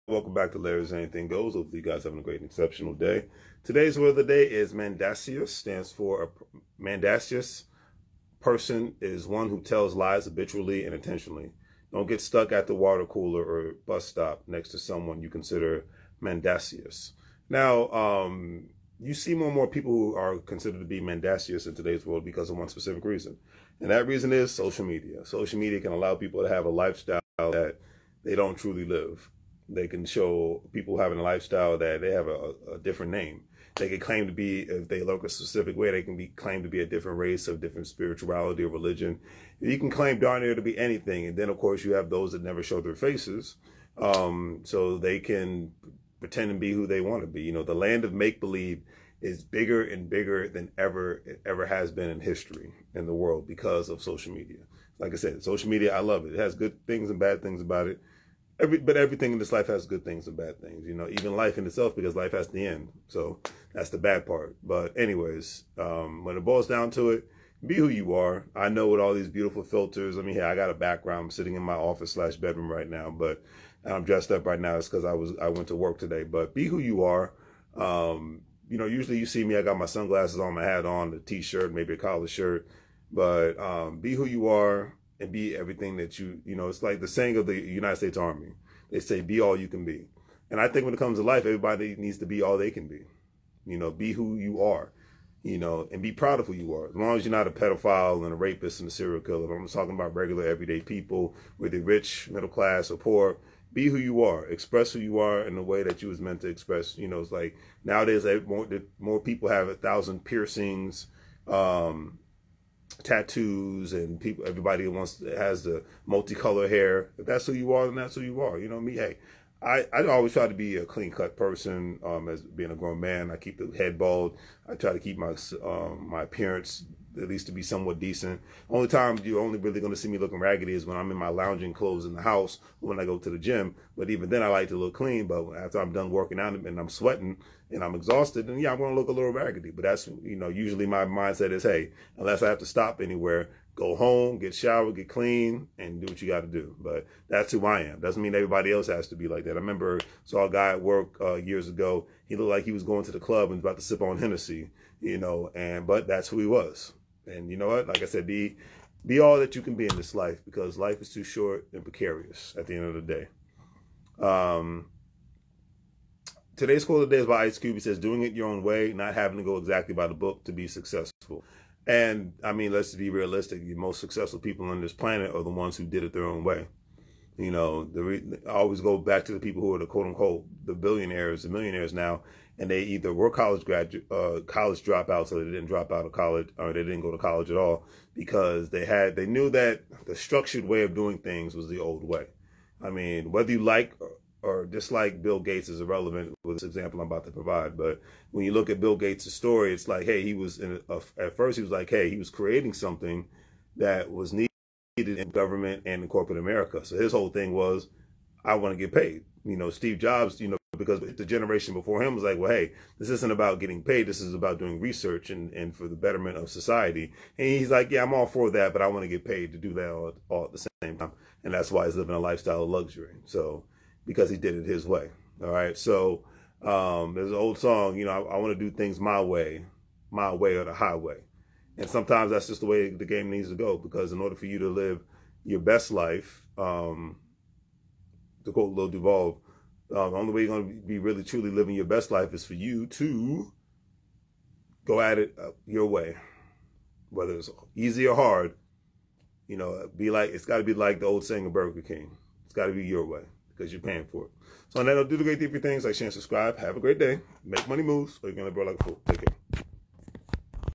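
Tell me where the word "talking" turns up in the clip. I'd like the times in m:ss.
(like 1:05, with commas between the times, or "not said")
1:39.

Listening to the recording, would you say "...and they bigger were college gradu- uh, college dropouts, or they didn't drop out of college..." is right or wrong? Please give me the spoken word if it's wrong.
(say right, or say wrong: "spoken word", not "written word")
wrong: "either", not "bigger".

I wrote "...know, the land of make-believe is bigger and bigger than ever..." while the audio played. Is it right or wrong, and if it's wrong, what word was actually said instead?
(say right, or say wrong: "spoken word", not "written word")
right.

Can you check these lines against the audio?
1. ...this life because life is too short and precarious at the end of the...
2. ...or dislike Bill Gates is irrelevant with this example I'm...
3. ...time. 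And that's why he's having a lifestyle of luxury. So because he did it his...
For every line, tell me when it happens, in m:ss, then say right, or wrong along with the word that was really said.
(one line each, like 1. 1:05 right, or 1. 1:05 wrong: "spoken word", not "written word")
1. 2:39 right
2. 3:14 right
3. 3:40 wrong: "living", not "having".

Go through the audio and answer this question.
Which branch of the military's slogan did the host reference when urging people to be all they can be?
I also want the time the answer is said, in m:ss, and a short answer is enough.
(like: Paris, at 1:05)
United States Army, at 1:27.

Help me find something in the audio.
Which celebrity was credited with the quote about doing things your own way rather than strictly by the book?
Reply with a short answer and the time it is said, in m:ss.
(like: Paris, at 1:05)
Ice Cube, at 2:47.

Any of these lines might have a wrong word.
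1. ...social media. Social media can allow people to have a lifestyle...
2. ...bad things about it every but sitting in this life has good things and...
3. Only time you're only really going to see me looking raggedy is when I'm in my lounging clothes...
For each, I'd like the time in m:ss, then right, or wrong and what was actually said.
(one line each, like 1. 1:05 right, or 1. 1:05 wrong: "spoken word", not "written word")
1. 0:24 right
2. 0:57 wrong: "everything", not "sitting"
3. 2:08 right.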